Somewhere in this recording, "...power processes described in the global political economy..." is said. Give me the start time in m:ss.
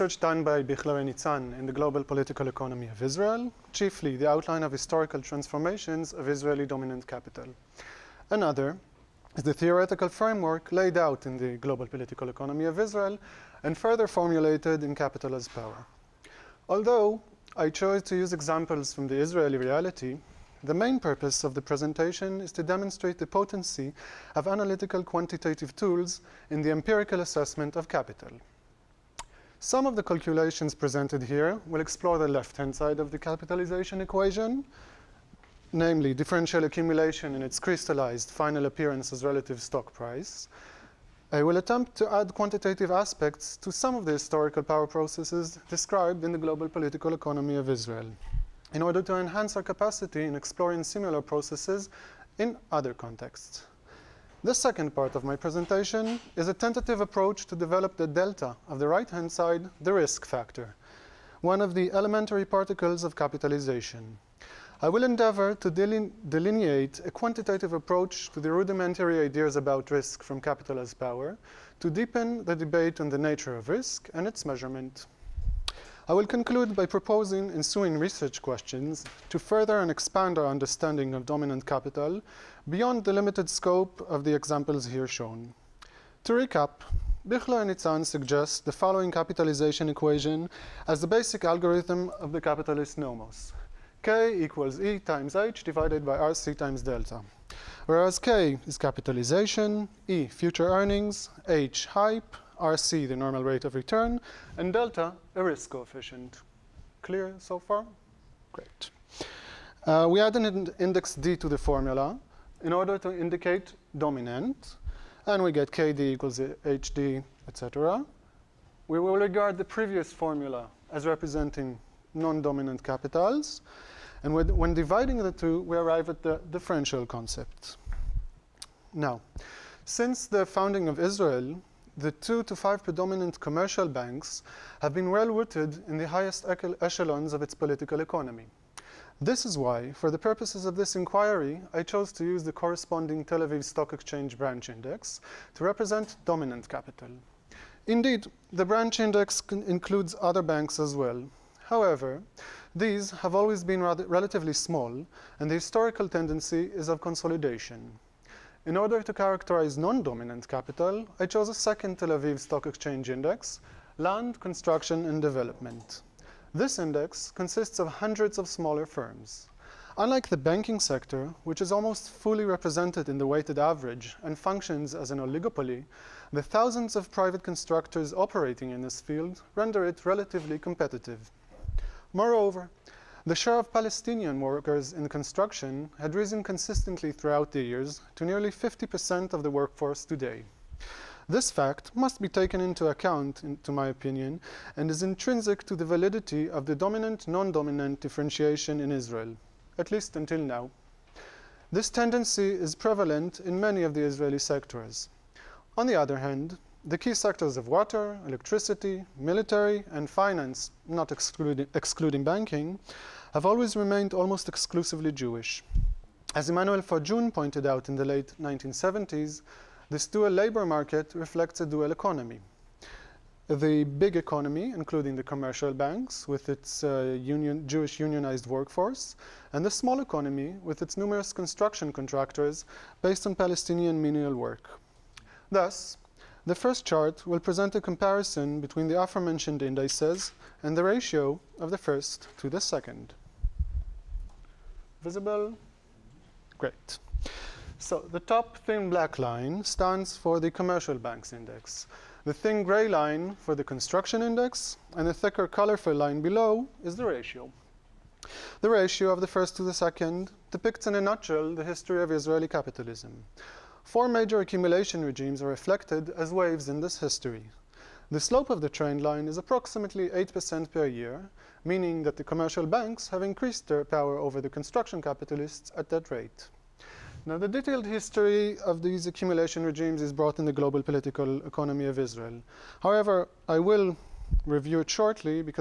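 0:44.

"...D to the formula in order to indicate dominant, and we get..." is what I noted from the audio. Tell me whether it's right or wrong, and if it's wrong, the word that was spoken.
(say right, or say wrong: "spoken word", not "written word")
right.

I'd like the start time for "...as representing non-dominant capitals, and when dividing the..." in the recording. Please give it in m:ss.
2:00.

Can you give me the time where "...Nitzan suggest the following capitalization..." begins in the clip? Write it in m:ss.
1:27.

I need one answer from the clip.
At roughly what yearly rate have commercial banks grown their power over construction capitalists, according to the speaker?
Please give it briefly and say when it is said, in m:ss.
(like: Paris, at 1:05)
8% per year, at 4:30.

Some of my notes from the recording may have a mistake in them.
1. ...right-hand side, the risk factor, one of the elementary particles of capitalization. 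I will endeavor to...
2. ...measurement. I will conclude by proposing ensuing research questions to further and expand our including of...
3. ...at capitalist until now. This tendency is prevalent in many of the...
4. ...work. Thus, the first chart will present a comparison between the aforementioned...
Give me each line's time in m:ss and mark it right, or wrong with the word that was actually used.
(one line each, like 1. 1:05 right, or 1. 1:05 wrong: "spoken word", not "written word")
1. 0:58 right
2. 1:14 wrong: "understanding", not "including"
3. 3:19 wrong: "least", not "capitalist"
4. 3:54 right.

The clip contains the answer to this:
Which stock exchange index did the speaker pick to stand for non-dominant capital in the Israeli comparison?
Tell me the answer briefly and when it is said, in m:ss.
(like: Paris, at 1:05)
Land, Construction, and Development, at 2:43.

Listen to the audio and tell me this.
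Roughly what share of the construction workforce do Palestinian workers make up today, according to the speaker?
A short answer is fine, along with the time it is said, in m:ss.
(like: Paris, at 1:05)
50%, at 3:08.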